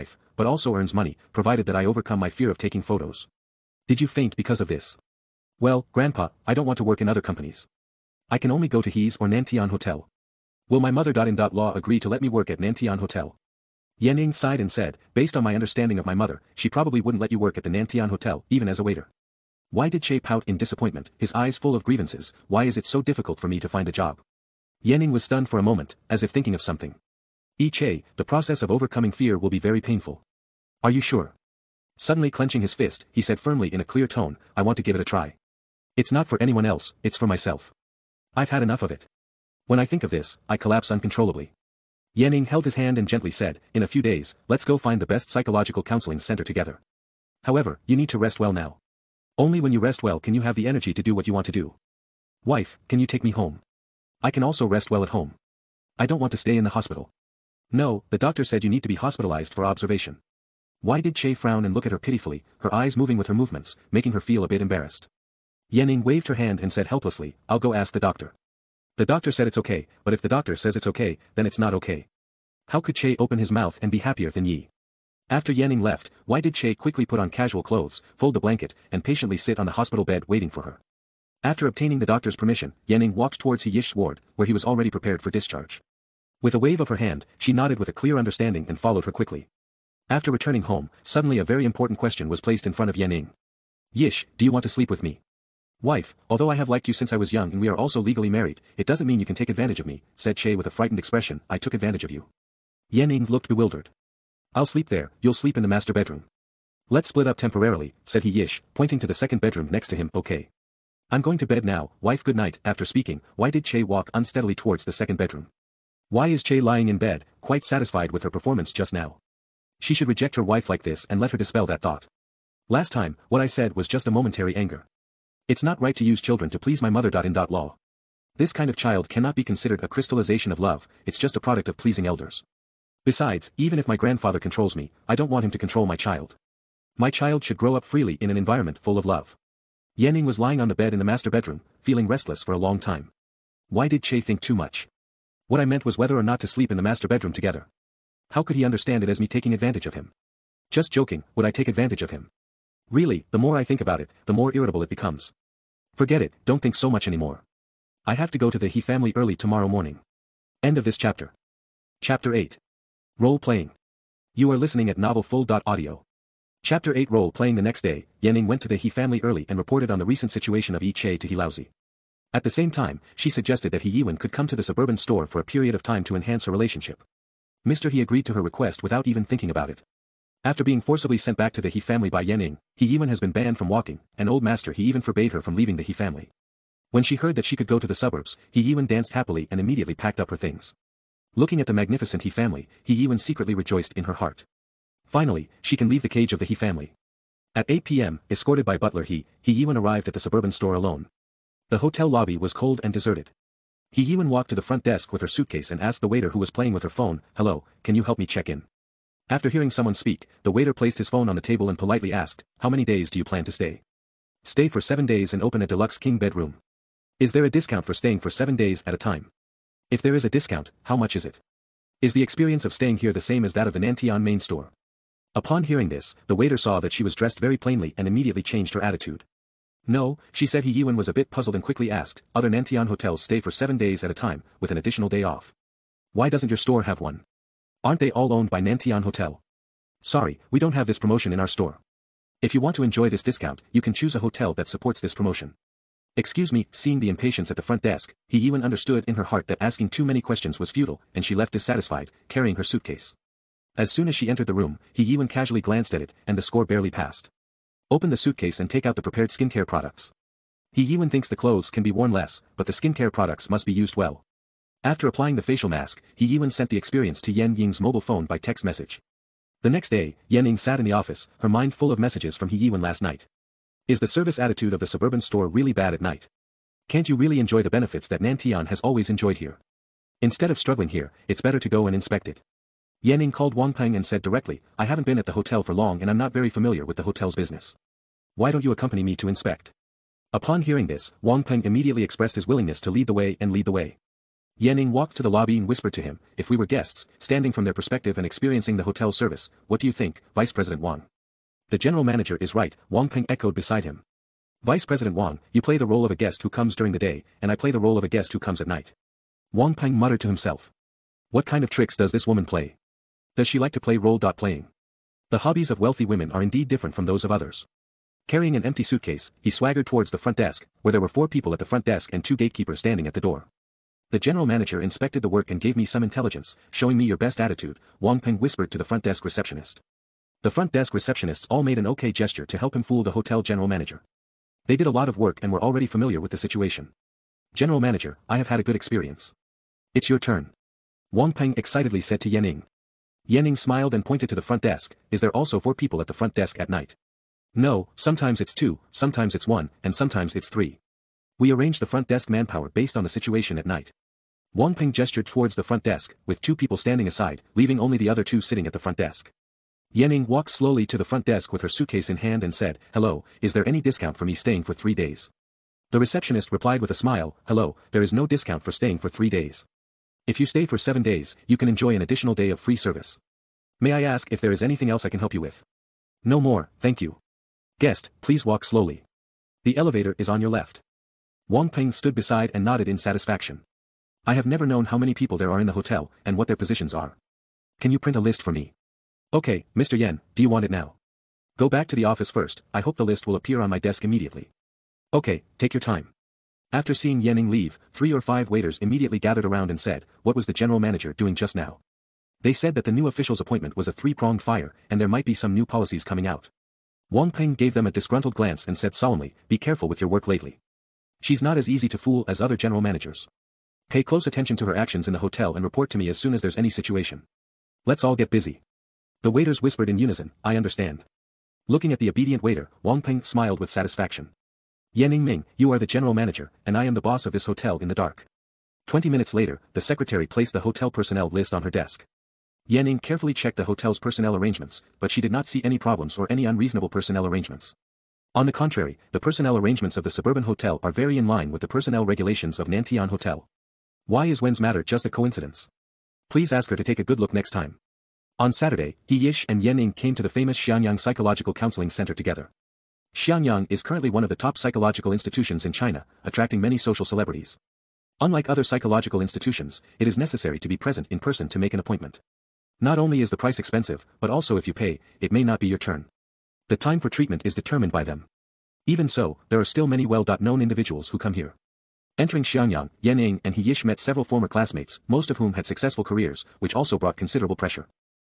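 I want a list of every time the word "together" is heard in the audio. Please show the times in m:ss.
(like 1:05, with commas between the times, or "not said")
0:46, 2:27, 7:32.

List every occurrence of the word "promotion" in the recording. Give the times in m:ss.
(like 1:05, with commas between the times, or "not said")
4:00, 4:05.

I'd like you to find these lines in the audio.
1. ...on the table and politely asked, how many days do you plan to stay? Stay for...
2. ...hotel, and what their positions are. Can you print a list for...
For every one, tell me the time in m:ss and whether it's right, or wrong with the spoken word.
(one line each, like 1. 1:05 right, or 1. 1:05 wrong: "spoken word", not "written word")
1. 3:31 right
2. 6:25 right.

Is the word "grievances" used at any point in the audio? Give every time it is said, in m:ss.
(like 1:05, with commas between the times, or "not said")
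0:21.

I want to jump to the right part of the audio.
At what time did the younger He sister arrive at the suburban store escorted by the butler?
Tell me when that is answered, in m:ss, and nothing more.
3:17.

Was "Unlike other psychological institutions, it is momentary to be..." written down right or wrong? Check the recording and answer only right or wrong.
wrong.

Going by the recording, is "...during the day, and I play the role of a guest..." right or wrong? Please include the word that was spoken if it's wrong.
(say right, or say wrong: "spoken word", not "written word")
right.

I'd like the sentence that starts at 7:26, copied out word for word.
Please ask her to take a good look next time.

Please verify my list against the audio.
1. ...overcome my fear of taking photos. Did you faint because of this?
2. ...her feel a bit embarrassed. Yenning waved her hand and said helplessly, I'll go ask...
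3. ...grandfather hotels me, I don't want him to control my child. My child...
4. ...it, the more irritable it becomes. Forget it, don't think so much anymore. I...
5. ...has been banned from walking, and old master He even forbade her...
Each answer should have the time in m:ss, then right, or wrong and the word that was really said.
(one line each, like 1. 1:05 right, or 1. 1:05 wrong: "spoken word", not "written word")
1. 0:01 right
2. 1:04 right
3. 2:13 wrong: "controls", not "hotels"
4. 2:33 right
5. 3:03 right.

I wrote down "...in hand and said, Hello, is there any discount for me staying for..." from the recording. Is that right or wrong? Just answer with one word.
right.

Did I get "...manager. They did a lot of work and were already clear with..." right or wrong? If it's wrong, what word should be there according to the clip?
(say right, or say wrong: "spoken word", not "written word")
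wrong: "familiar", not "clear".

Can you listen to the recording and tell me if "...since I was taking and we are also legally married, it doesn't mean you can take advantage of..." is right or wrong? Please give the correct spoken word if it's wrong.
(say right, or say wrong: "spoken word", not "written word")
wrong: "young", not "taking".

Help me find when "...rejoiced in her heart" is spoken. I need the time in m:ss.
3:13.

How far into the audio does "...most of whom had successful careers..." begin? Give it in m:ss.
7:55.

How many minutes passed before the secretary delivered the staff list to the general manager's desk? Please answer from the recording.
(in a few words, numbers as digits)
20.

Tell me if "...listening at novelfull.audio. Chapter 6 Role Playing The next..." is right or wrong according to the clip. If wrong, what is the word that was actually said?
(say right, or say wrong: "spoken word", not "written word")
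wrong: "8", not "6".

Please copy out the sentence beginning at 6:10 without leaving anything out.
If you stay for seven days, you can enjoy an additional day of free service.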